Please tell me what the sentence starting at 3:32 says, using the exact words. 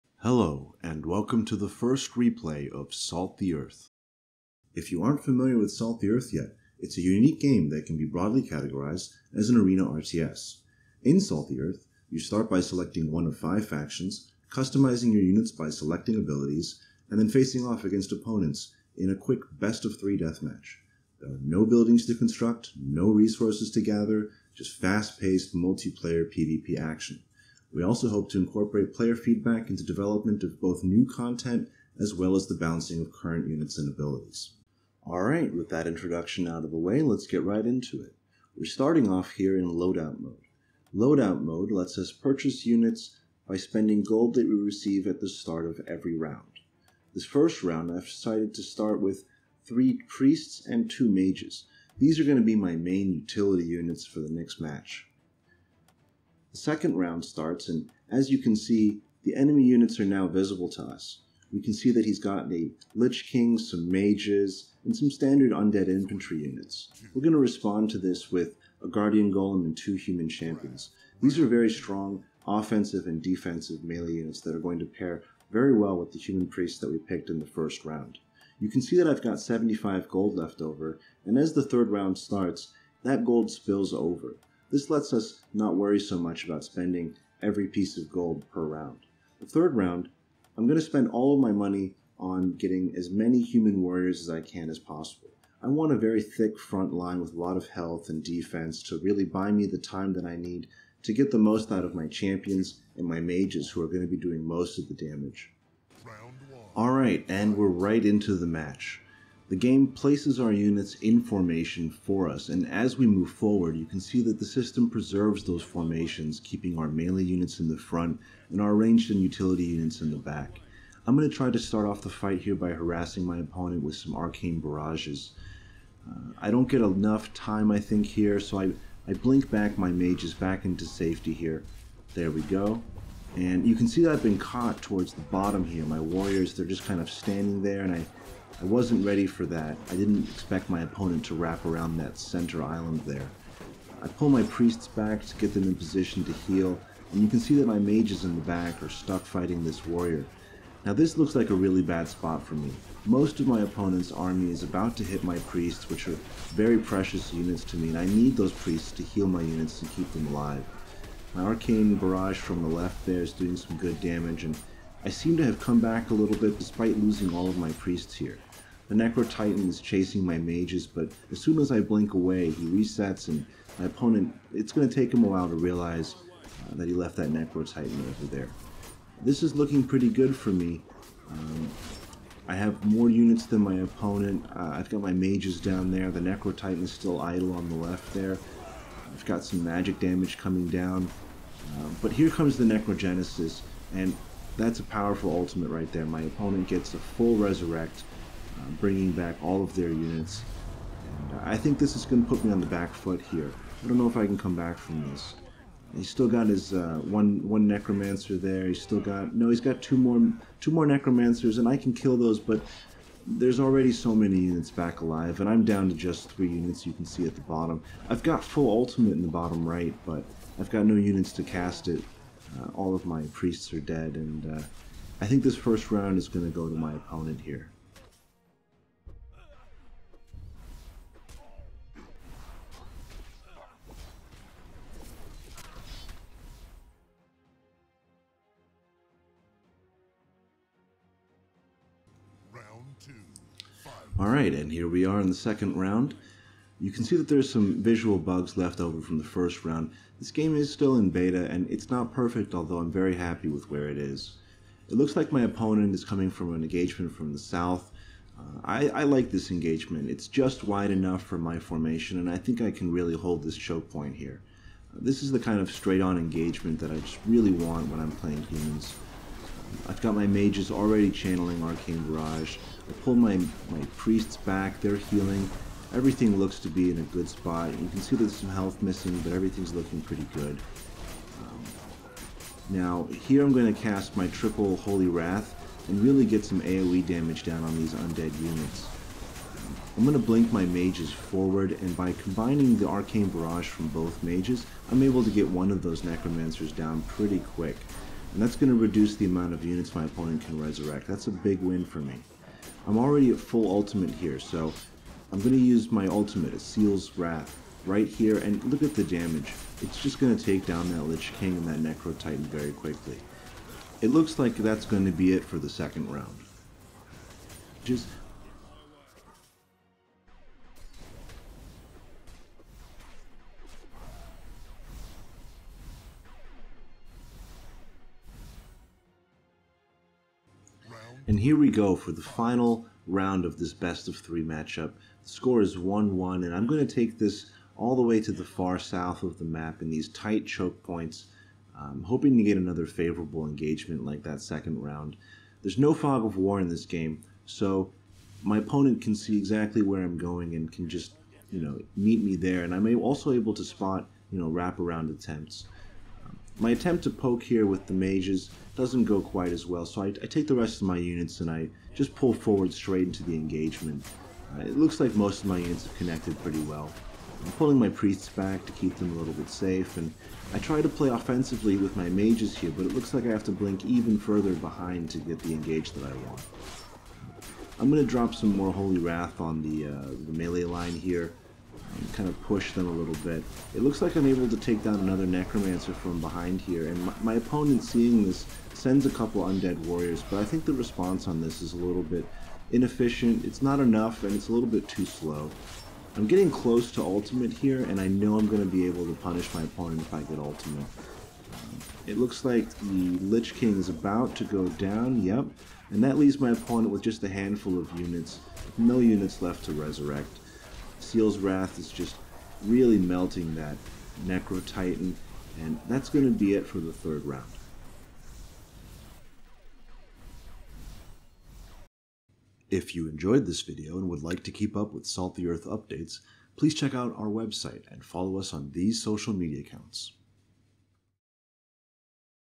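But there's already so many units back alive, and I'm down to just three units you can see at the bottom.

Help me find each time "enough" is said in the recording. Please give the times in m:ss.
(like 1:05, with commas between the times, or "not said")
2:06, 4:20, 6:33.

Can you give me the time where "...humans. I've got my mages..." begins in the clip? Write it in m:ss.
4:28.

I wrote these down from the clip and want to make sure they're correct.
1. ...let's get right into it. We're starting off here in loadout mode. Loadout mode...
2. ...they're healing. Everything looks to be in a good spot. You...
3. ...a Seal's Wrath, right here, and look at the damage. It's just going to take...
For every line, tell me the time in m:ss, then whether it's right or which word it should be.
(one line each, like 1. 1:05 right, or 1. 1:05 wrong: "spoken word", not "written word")
1. 0:37 right
2. 4:34 right
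3. 5:06 right.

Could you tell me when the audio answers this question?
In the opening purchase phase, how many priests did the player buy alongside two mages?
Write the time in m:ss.
0:49.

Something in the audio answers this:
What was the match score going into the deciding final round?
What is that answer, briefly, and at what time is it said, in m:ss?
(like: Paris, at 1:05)
1-1, at 5:35.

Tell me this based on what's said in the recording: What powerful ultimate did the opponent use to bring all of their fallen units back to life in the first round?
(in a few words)
Necrogenesis.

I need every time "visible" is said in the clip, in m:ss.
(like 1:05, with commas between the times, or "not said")
1:00.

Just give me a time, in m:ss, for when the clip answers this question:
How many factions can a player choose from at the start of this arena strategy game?
0:13.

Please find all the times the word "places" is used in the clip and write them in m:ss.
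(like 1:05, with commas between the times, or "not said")
1:49.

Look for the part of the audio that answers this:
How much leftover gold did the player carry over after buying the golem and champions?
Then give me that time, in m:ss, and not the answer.
1:19.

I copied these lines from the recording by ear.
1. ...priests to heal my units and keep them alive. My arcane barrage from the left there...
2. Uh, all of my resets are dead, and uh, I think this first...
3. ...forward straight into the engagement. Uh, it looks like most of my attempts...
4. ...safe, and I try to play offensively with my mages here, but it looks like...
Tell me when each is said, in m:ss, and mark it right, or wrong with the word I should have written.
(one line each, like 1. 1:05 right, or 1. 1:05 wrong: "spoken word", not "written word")
1. 2:38 right
2. 3:42 wrong: "priests", not "resets"
3. 6:02 wrong: "units", not "attempts"
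4. 6:09 right.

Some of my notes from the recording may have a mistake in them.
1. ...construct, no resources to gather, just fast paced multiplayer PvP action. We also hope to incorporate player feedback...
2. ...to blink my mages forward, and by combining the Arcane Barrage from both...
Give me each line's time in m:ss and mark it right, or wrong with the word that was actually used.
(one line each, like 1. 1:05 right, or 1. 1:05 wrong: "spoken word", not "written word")
1. 0:22 right
2. 4:50 right.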